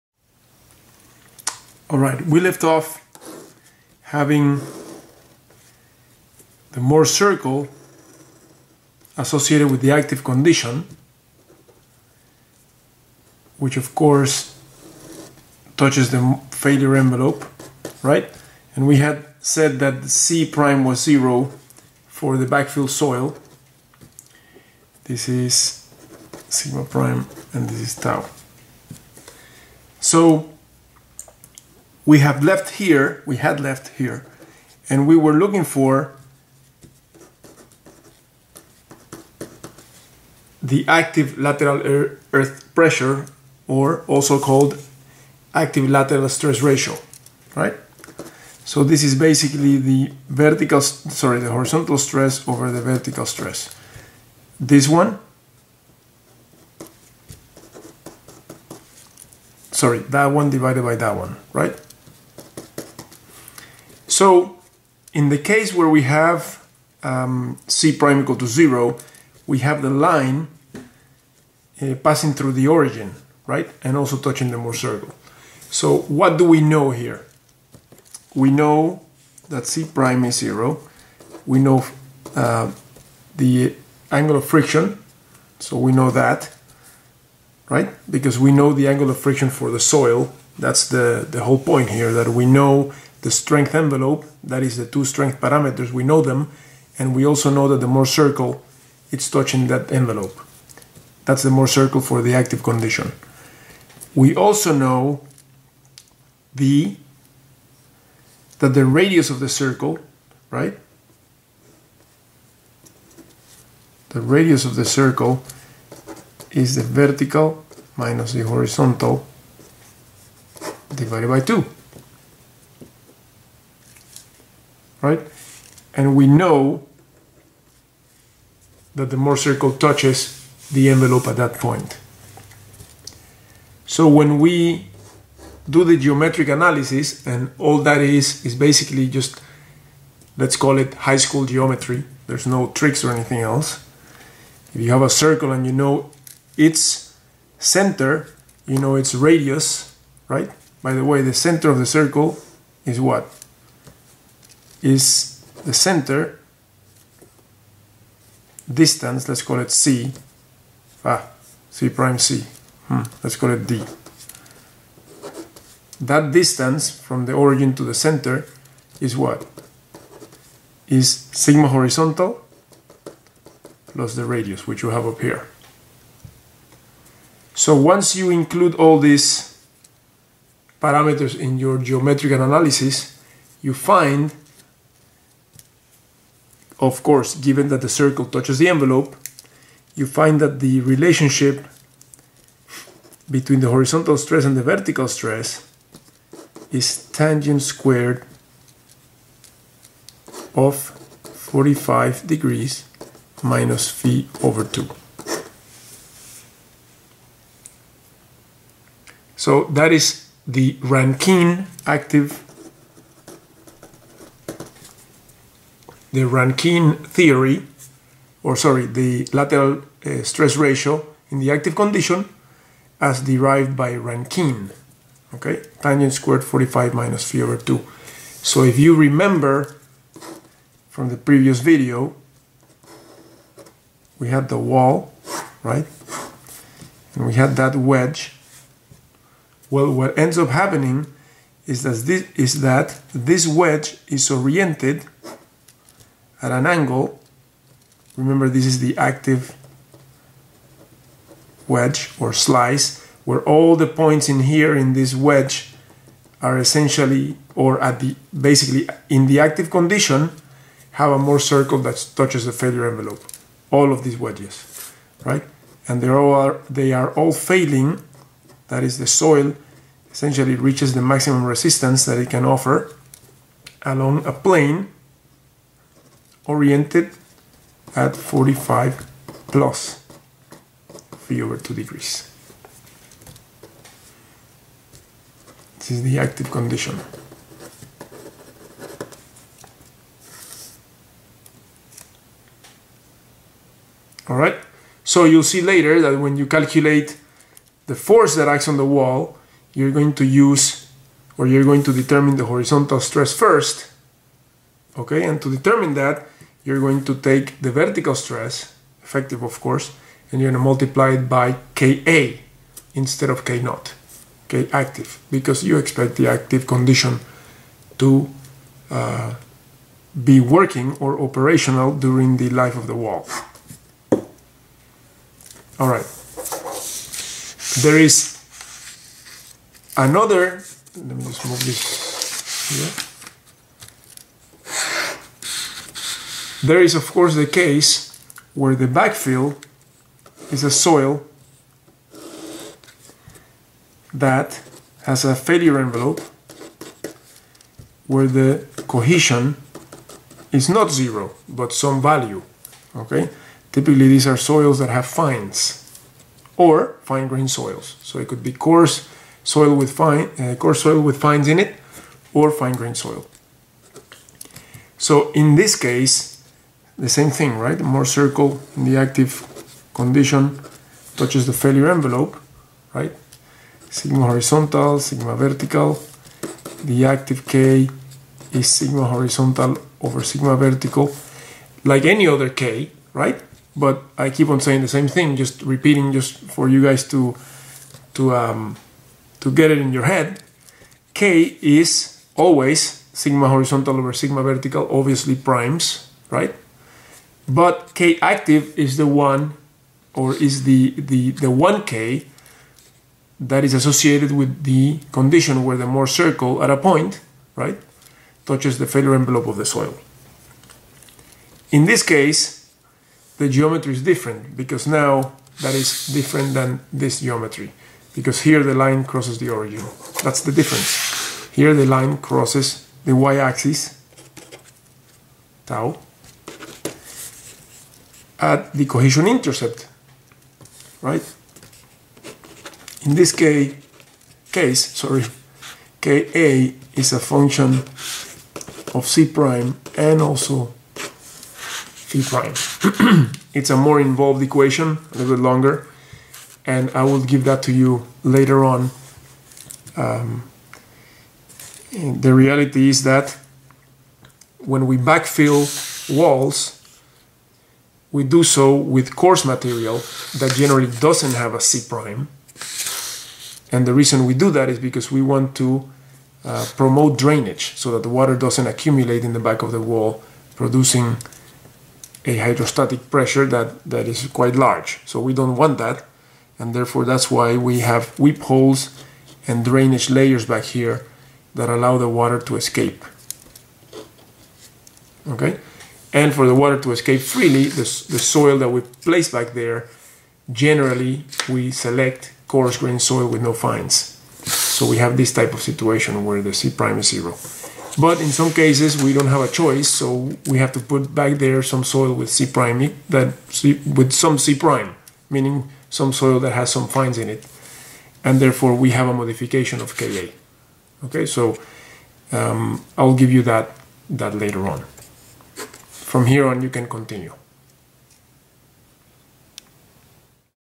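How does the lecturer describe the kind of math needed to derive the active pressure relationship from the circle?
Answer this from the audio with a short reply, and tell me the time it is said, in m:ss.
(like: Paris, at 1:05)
high school geometry, at 2:20.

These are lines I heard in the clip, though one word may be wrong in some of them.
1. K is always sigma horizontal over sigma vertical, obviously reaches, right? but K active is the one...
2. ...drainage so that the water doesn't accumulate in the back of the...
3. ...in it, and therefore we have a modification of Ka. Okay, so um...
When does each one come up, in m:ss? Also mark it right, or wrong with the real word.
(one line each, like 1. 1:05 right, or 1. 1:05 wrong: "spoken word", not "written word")
1. 6:31 wrong: "primes", not "reaches"
2. 7:47 right
3. 8:27 right.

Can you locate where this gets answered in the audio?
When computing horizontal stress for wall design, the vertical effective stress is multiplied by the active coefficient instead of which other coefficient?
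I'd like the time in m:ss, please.
5:13.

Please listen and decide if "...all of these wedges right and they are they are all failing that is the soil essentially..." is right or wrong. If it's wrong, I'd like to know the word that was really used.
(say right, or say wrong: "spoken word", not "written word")
right.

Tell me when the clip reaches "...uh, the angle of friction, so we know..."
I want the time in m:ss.
1:22.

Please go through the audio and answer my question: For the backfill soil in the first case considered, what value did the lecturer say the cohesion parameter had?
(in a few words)
0.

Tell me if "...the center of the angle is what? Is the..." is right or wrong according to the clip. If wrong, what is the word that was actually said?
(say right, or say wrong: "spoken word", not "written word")
wrong: "circle", not "angle".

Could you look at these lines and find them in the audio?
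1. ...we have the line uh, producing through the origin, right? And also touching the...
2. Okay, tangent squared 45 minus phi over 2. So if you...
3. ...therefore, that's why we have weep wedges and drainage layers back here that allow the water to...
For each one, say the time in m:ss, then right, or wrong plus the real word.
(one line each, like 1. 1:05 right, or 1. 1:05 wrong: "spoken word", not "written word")
1. 1:09 wrong: "passing", not "producing"
2. 3:45 right
3. 7:56 wrong: "holes", not "wedges".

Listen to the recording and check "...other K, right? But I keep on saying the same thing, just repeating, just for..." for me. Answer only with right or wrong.
right.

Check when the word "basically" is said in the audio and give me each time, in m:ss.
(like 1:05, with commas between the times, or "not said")
0:49, 2:18, 4:18.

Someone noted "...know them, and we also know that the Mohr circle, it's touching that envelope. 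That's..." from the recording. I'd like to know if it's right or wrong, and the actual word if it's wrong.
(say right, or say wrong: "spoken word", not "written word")
right.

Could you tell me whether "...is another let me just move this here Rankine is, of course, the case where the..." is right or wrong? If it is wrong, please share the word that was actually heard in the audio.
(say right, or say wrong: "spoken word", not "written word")
wrong: "There", not "Rankine".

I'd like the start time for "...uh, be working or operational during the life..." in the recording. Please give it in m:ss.
5:18.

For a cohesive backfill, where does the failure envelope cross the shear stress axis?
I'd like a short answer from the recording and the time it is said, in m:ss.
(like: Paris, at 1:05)
cohesion intercept, at 7:08.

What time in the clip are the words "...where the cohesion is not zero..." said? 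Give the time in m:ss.
5:48.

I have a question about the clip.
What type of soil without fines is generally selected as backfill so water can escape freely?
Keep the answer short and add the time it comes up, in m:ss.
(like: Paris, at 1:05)
coarse grain soil, at 8:12.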